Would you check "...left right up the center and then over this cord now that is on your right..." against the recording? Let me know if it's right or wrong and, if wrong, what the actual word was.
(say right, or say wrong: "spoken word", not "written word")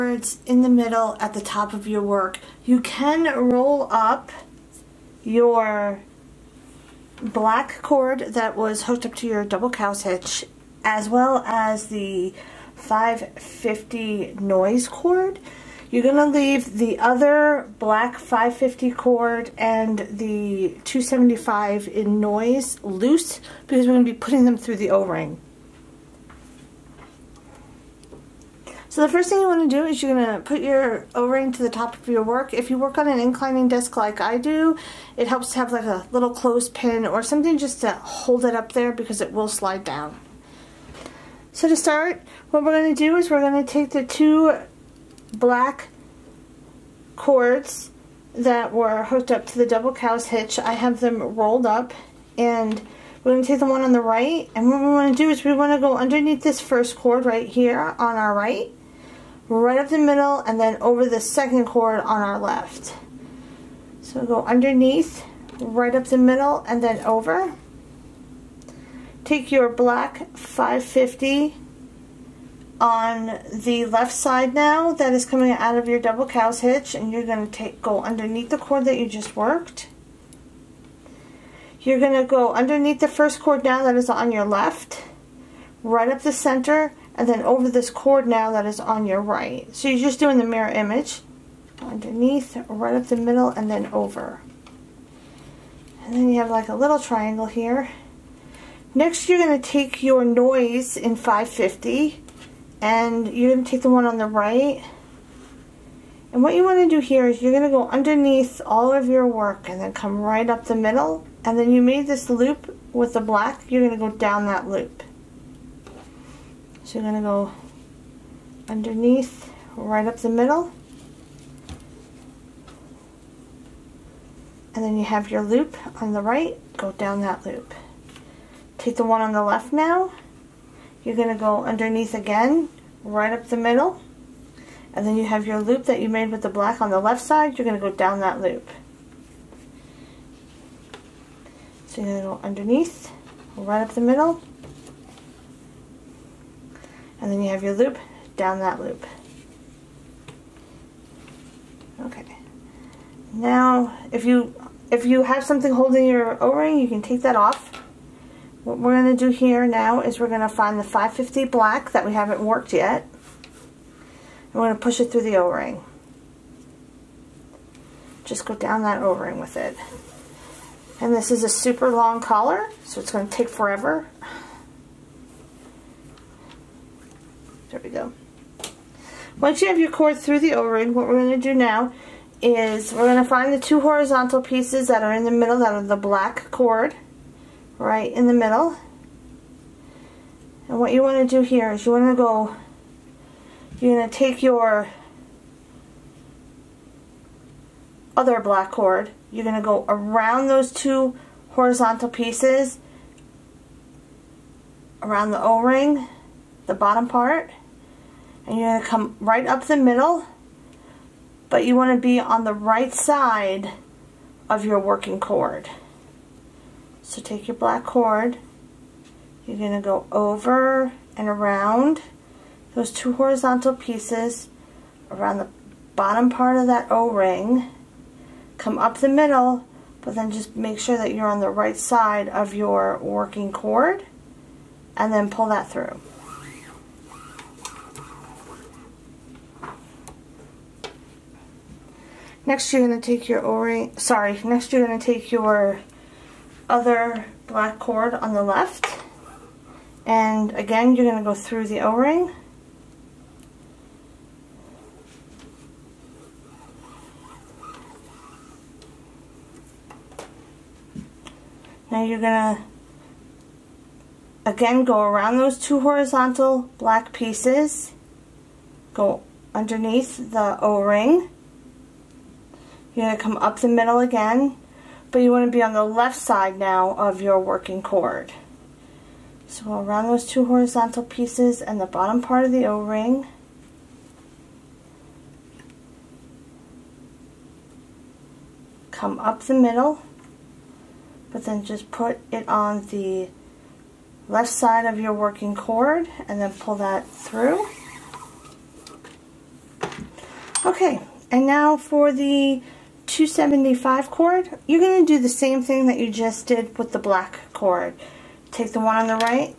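right.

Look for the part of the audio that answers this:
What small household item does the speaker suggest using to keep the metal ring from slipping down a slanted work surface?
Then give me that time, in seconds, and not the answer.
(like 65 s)
36 s.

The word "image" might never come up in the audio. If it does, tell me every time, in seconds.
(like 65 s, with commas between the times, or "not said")
90 s.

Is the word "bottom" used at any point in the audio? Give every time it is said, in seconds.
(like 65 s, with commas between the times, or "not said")
206 s, 225 s, 281 s.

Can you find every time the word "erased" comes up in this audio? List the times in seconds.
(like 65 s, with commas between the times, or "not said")
not said.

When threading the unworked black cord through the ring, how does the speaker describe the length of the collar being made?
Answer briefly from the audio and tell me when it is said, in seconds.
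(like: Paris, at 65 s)
super long, at 171 s.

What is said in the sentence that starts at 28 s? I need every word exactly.
So the first thing you want to do is you're going to put your O-ring to the top of your work.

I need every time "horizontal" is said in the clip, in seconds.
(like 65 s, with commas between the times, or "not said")
183 s, 201 s, 223 s, 265 s, 280 s.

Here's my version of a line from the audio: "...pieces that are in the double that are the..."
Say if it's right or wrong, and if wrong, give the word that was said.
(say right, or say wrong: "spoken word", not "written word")
wrong: "middle", not "double".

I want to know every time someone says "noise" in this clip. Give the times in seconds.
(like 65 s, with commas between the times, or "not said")
14 s, 22 s, 100 s.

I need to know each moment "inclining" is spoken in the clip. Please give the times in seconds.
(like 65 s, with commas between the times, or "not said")
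33 s.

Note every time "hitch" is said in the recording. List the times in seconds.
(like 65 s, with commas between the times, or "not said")
10 s, 50 s, 76 s.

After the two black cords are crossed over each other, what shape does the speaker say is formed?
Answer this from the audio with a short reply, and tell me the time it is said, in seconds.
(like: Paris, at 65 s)
triangle, at 96 s.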